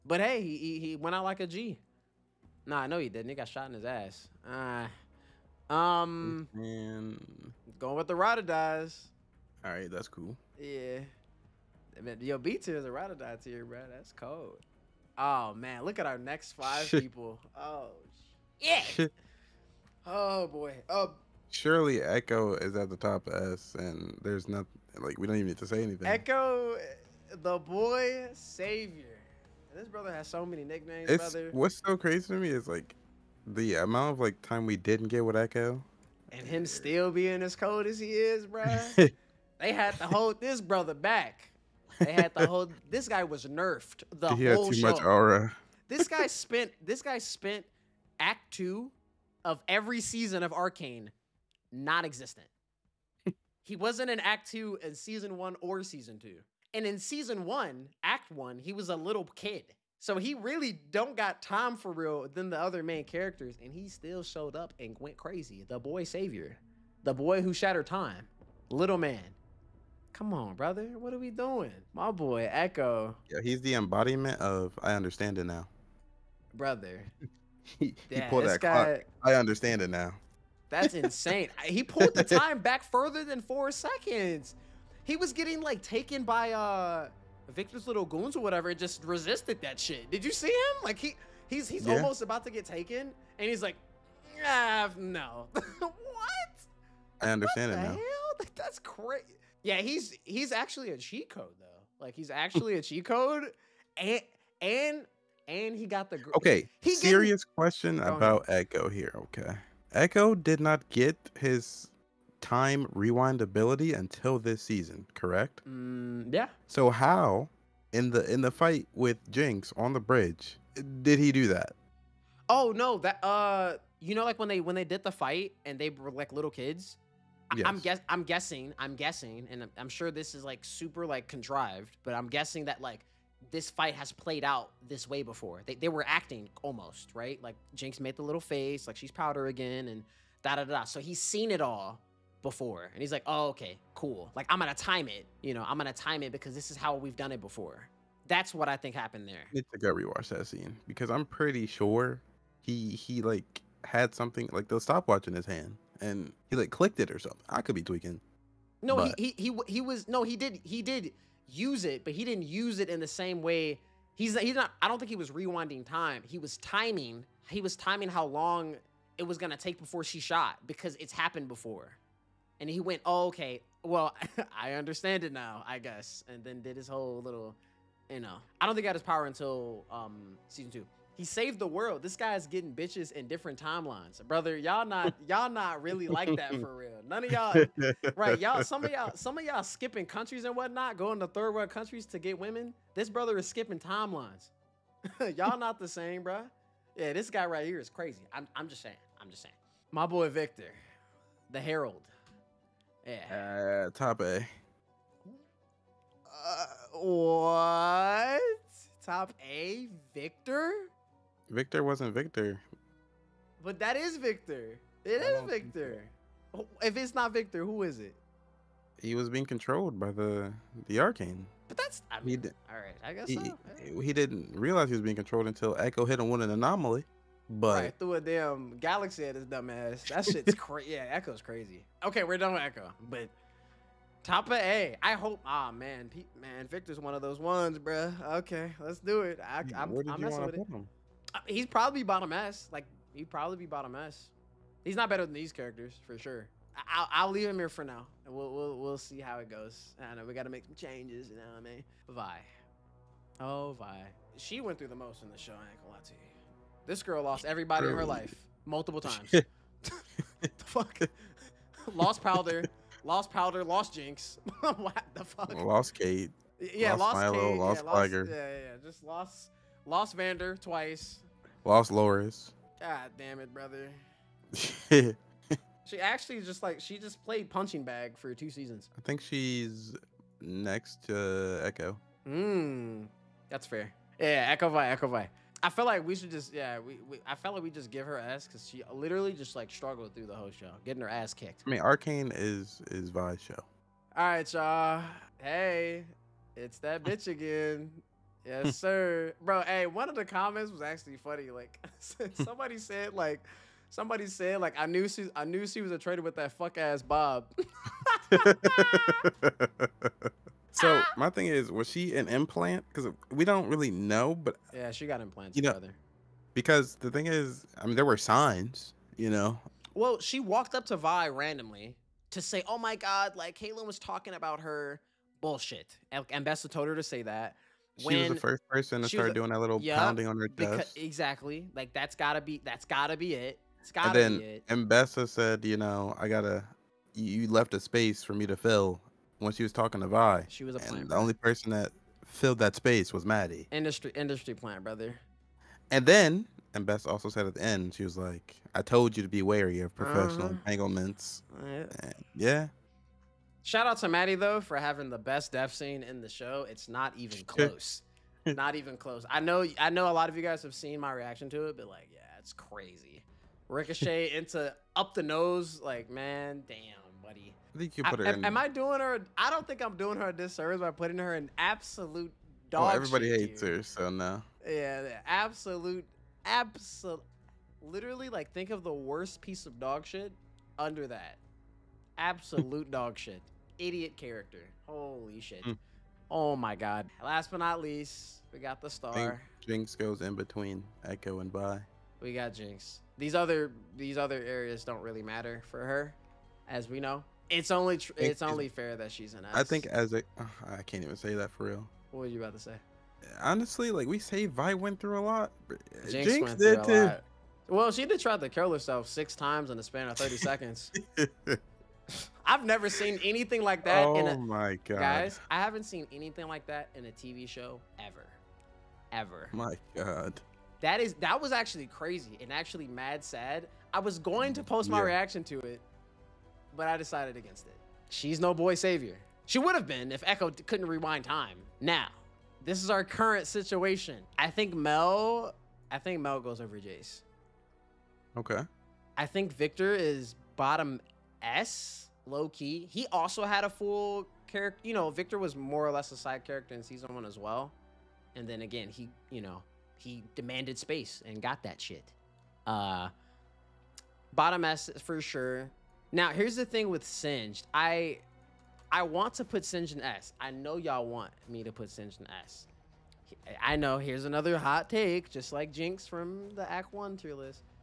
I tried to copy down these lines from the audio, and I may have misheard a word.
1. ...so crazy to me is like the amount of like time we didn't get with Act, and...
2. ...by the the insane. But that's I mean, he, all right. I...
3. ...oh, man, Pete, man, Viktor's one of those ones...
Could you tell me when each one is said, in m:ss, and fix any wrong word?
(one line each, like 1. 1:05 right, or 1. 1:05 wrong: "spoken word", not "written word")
1. 0:31 wrong: "Ekko", not "Act"
2. 3:39 wrong: "arcane", not "insane"
3. 3:55 right.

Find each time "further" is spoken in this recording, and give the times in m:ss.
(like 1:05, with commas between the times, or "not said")
1:22.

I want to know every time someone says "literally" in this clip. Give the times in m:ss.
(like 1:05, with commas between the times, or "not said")
4:48, 6:17.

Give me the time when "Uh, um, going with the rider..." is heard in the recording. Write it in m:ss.
0:04.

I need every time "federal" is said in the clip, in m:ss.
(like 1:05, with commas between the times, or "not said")
not said.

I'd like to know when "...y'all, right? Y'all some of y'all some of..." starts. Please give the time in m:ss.
3:07.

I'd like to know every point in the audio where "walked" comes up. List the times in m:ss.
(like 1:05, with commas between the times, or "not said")
5:20.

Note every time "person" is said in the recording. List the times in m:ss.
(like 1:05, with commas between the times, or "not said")
5:28, 5:41.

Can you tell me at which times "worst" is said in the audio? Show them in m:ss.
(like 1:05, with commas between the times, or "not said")
6:18.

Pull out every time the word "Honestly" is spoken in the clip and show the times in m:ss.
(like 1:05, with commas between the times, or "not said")
6:43.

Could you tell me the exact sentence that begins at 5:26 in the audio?
And Ambessa told her to say that.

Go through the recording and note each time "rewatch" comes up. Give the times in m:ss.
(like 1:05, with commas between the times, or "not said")
2:29.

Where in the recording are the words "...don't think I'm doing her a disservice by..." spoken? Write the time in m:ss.
6:09.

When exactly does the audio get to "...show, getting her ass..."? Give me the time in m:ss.
4:50.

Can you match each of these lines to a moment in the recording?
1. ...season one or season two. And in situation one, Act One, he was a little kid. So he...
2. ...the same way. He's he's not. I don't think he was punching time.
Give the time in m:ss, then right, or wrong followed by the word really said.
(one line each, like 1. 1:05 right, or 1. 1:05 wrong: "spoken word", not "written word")
1. 0:54 wrong: "season", not "situation"
2. 2:42 wrong: "rewinding", not "punching".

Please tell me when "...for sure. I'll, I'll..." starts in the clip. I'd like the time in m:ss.
4:06.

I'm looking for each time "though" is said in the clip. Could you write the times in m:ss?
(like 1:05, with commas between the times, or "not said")
1:41, 5:54.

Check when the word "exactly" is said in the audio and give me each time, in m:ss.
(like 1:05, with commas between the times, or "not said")
5:30.